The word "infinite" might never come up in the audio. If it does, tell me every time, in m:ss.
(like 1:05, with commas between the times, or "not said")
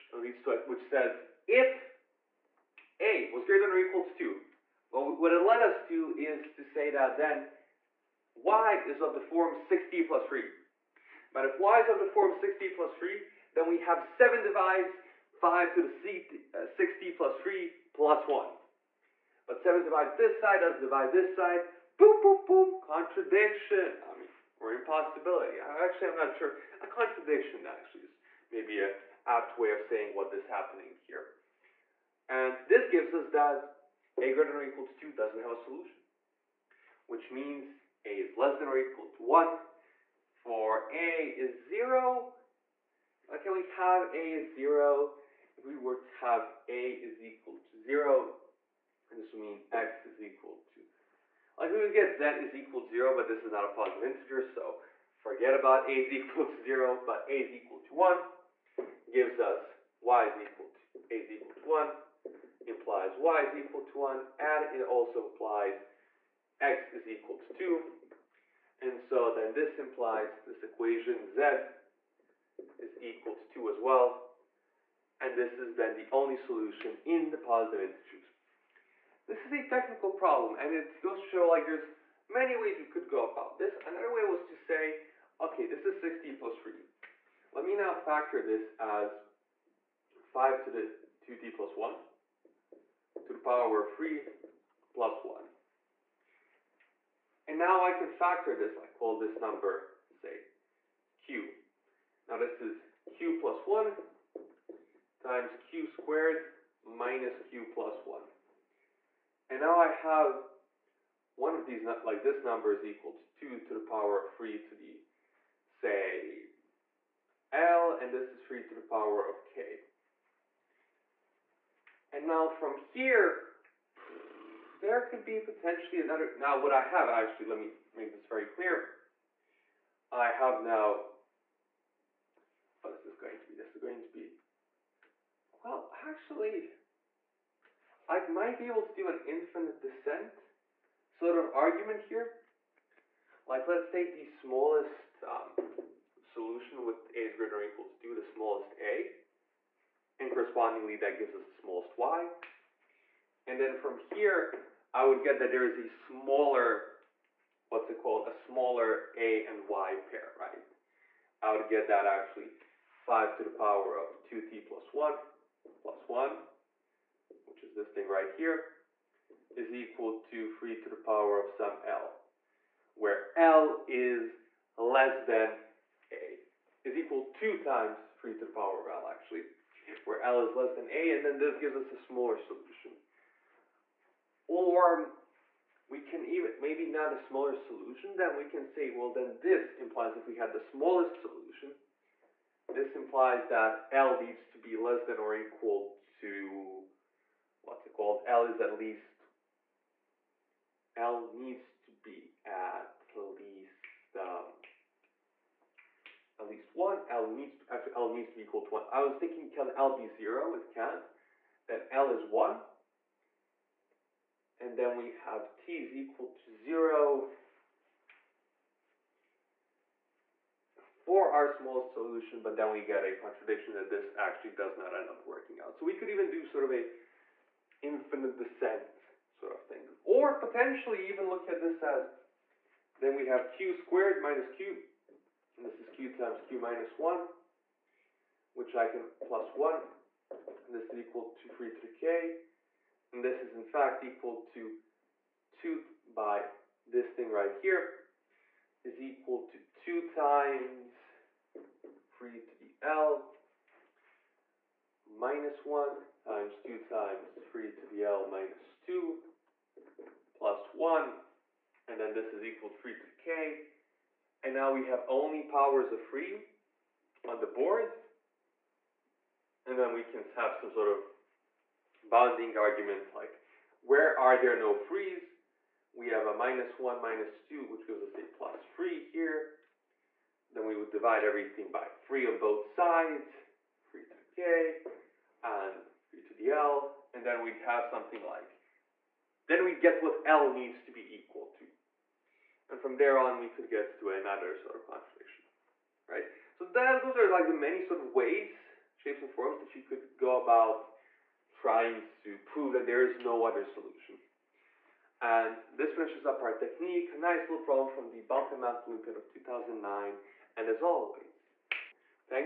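2:19, 3:47.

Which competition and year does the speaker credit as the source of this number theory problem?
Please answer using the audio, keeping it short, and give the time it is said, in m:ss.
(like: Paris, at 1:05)
Balkan Math Olympiad 2009, at 5:08.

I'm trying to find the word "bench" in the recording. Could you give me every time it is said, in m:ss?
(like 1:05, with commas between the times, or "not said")
not said.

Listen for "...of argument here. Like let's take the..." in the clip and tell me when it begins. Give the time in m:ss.
2:21.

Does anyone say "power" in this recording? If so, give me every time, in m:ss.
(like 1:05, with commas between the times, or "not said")
1:33, 1:53, 1:58, 2:43, 2:50, 2:58, 4:25.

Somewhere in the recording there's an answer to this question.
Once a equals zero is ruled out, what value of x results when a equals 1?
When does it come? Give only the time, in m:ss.
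1:06.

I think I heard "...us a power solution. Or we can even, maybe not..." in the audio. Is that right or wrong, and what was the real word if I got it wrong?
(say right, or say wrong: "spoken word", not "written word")
wrong: "smaller", not "power".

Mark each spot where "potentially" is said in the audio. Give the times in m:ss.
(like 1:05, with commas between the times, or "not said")
2:05, 3:50.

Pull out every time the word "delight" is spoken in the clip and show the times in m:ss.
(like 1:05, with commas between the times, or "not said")
not said.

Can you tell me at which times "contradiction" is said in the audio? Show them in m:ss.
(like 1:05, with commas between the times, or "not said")
0:22, 0:26, 3:43, 4:54.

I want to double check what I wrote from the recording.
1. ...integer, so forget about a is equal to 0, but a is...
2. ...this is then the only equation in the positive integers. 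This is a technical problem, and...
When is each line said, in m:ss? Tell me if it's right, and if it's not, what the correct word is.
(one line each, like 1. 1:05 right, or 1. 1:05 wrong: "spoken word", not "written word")
1. 0:54 right
2. 1:15 wrong: "solution", not "equation".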